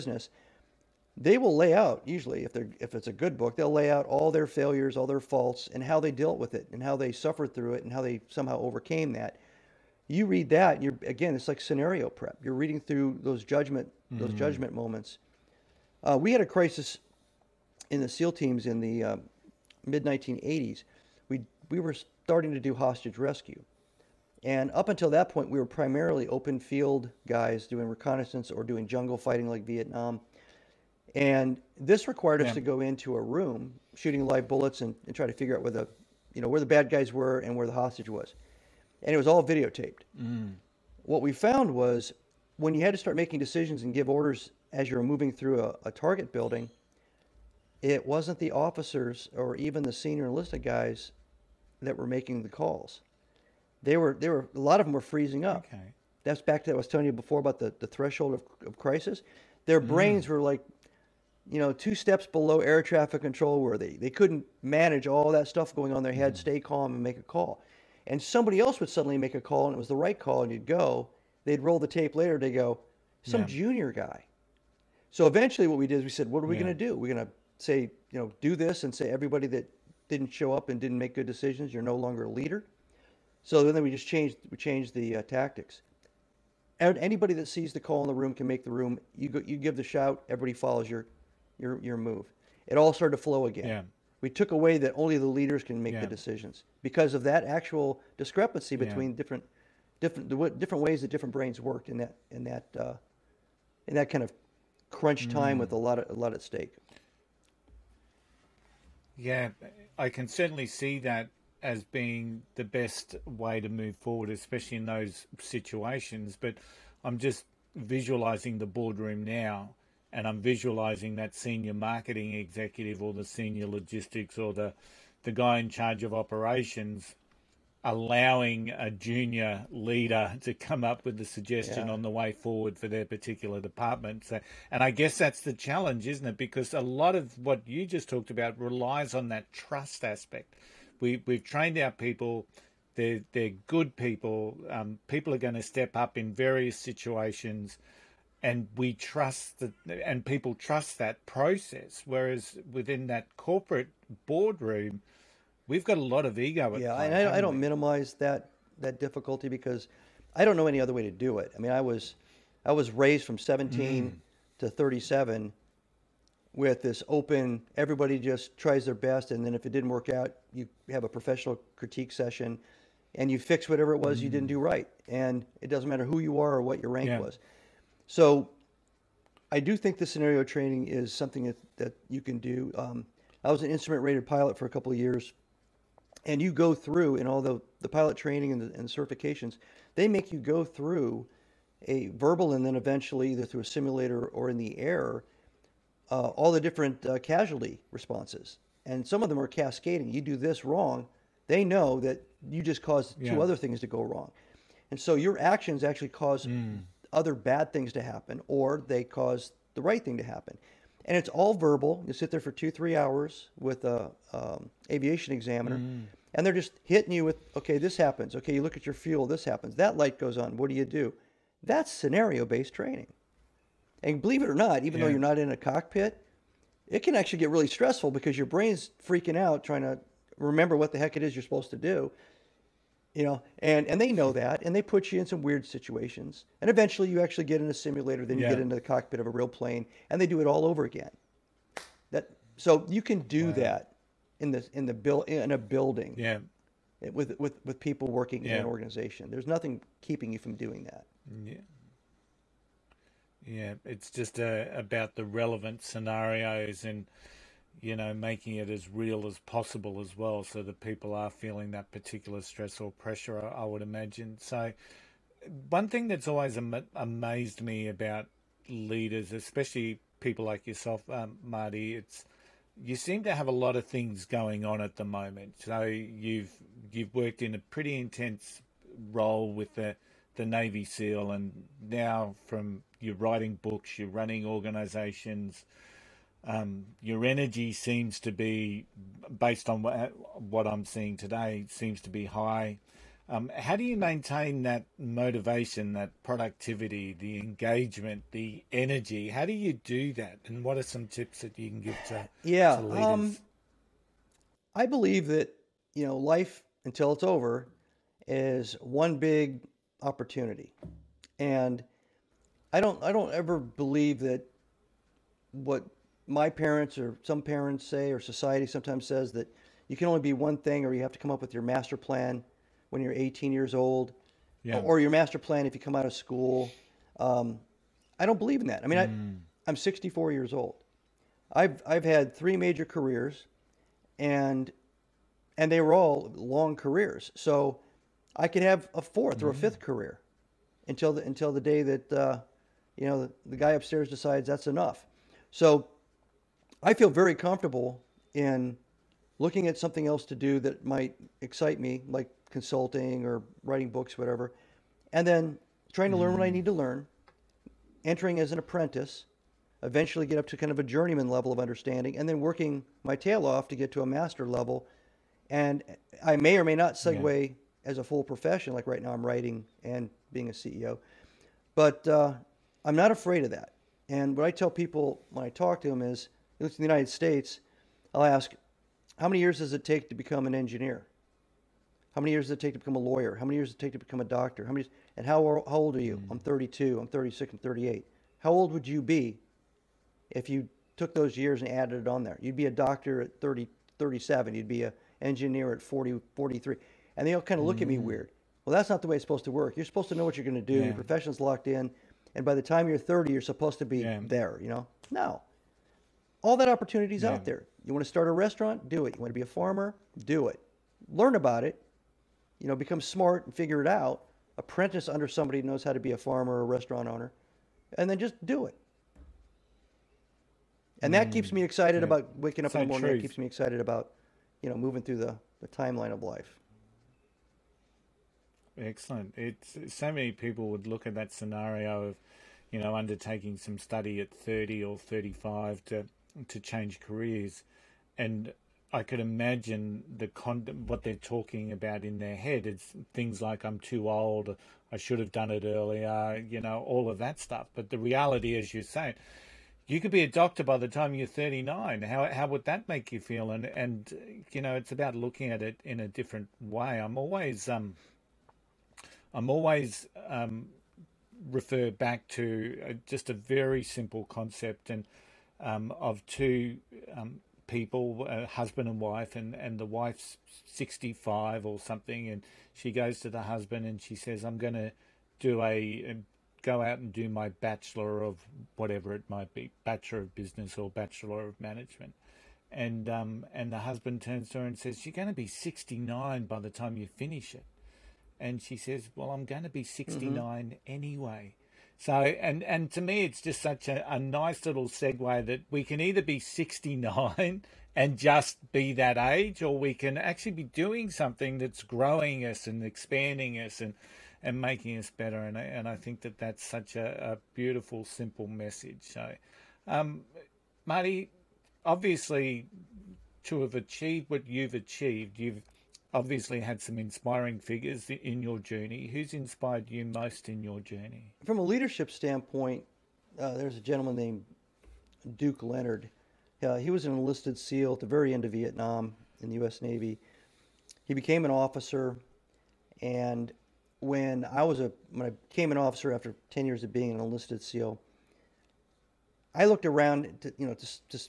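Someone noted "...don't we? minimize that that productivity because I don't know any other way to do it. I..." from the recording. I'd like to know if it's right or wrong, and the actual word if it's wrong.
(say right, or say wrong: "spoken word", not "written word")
wrong: "difficulty", not "productivity".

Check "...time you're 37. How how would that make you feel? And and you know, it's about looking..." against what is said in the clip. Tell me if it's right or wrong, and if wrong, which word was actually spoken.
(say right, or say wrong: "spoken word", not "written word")
wrong: "39", not "37".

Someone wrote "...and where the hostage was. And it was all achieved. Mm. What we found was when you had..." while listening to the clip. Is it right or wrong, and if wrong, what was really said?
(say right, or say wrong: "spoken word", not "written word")
wrong: "videotaped", not "achieved".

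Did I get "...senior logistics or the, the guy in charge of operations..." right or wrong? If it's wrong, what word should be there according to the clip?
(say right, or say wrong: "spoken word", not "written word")
right.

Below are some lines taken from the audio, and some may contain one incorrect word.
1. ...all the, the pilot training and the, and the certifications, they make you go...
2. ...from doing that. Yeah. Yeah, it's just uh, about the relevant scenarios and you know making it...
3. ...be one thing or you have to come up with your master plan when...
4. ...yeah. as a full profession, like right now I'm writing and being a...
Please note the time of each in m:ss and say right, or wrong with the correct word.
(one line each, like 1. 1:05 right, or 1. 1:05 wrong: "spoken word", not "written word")
1. 3:07 right
2. 4:10 right
3. 5:20 right
4. 6:07 right.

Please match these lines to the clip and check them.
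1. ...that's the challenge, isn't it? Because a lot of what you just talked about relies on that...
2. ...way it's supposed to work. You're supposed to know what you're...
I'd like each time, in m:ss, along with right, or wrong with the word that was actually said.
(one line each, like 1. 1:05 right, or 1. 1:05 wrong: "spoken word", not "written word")
1. 2:15 right
2. 6:39 right.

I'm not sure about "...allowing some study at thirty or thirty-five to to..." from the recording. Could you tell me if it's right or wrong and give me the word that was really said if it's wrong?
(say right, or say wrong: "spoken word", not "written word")
wrong: "undertaking", not "allowing".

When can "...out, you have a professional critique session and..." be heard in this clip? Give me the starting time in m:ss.
2:50.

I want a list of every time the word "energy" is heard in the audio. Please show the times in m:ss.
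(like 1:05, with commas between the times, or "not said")
4:47, 4:58.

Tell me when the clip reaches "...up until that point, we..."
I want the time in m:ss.
0:24.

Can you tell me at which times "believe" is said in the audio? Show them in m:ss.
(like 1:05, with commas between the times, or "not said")
3:44, 5:04, 5:13, 5:28.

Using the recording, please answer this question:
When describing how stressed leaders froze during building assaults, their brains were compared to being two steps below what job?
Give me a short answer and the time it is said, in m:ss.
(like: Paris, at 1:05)
air traffic control, at 1:02.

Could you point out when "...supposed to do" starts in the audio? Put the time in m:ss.
3:51.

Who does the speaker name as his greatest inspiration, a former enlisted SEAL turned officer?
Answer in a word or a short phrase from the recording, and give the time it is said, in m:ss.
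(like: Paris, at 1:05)
Duke Leonard, at 8:45.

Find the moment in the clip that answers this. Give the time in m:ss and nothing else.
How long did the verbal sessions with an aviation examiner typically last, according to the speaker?
3:32.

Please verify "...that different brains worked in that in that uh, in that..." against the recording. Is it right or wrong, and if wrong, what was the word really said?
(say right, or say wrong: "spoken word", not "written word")
right.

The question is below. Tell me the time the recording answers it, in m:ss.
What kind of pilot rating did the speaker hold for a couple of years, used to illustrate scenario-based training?
3:03.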